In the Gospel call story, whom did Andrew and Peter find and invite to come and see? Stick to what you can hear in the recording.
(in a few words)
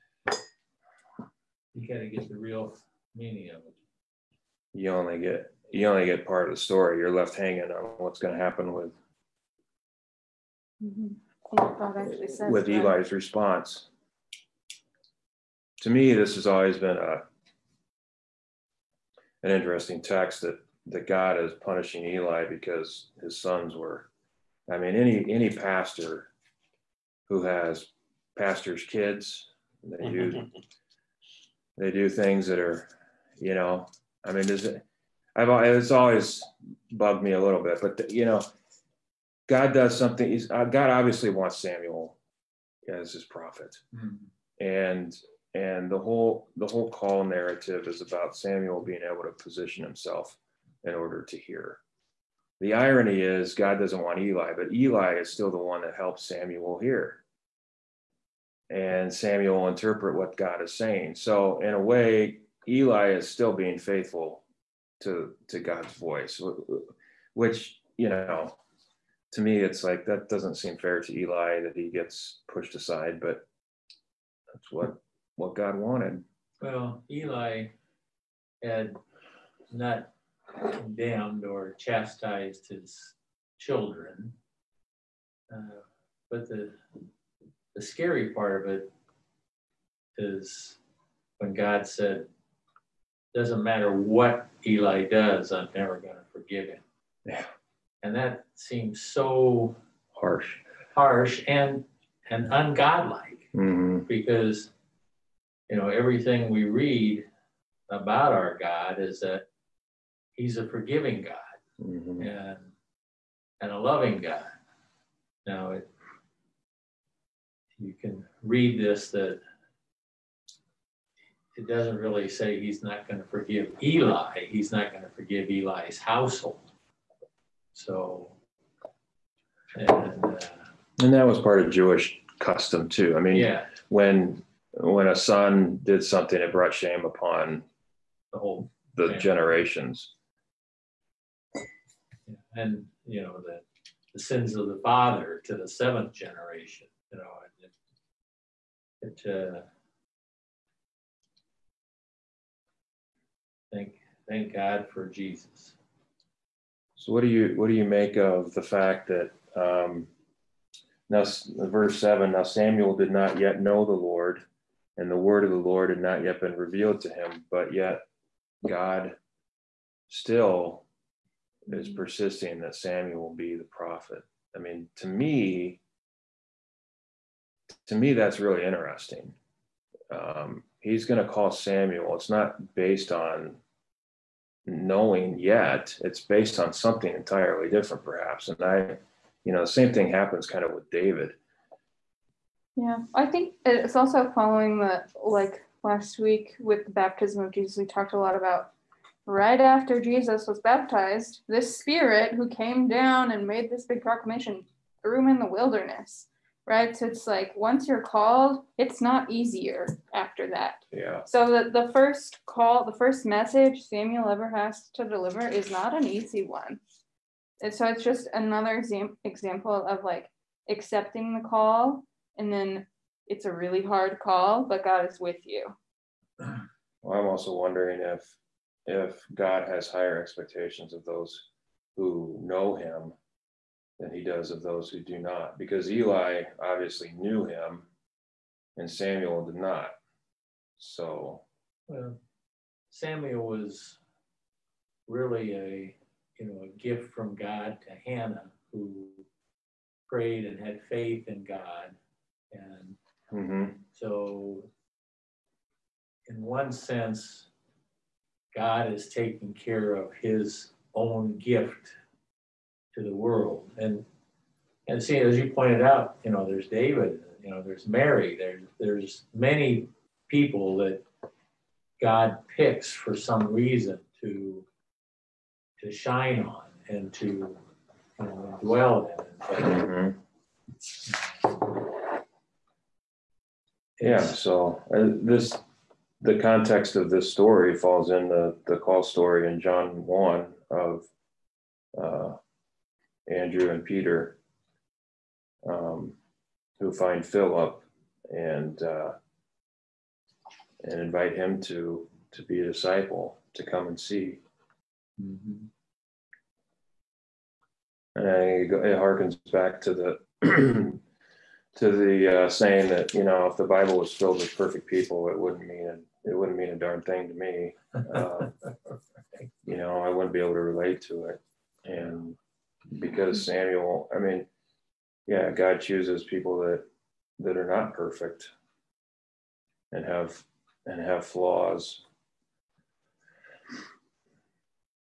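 Philip.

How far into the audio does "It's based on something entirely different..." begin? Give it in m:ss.
3:06.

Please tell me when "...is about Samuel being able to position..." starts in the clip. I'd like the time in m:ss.
0:47.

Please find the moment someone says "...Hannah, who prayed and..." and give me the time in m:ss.
4:08.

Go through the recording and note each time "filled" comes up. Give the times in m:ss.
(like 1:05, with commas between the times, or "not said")
5:14.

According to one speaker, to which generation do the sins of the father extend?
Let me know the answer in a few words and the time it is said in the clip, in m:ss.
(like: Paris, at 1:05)
seventh, at 2:25.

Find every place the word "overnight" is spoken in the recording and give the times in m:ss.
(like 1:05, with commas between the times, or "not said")
not said.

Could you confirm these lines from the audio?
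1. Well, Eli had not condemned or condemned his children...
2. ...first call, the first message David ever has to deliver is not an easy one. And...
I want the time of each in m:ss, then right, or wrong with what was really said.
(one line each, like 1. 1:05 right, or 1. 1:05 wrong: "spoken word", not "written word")
1. 1:16 wrong: "chastised", not "condemned"
2. 3:31 wrong: "Samuel", not "David".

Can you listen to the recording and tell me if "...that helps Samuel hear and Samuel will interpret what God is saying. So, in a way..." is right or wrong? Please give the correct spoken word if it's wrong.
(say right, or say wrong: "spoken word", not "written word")
right.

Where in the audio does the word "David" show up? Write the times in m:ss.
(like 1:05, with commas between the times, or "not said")
3:10, 4:26.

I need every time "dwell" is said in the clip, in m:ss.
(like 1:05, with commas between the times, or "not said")
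4:38.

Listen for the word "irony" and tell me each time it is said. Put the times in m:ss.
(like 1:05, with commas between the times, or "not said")
0:52.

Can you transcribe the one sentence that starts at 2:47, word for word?
But yet God still is mm-hmm.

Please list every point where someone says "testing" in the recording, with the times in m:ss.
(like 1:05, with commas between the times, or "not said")
not said.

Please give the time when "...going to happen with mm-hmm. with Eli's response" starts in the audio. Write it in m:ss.
0:08.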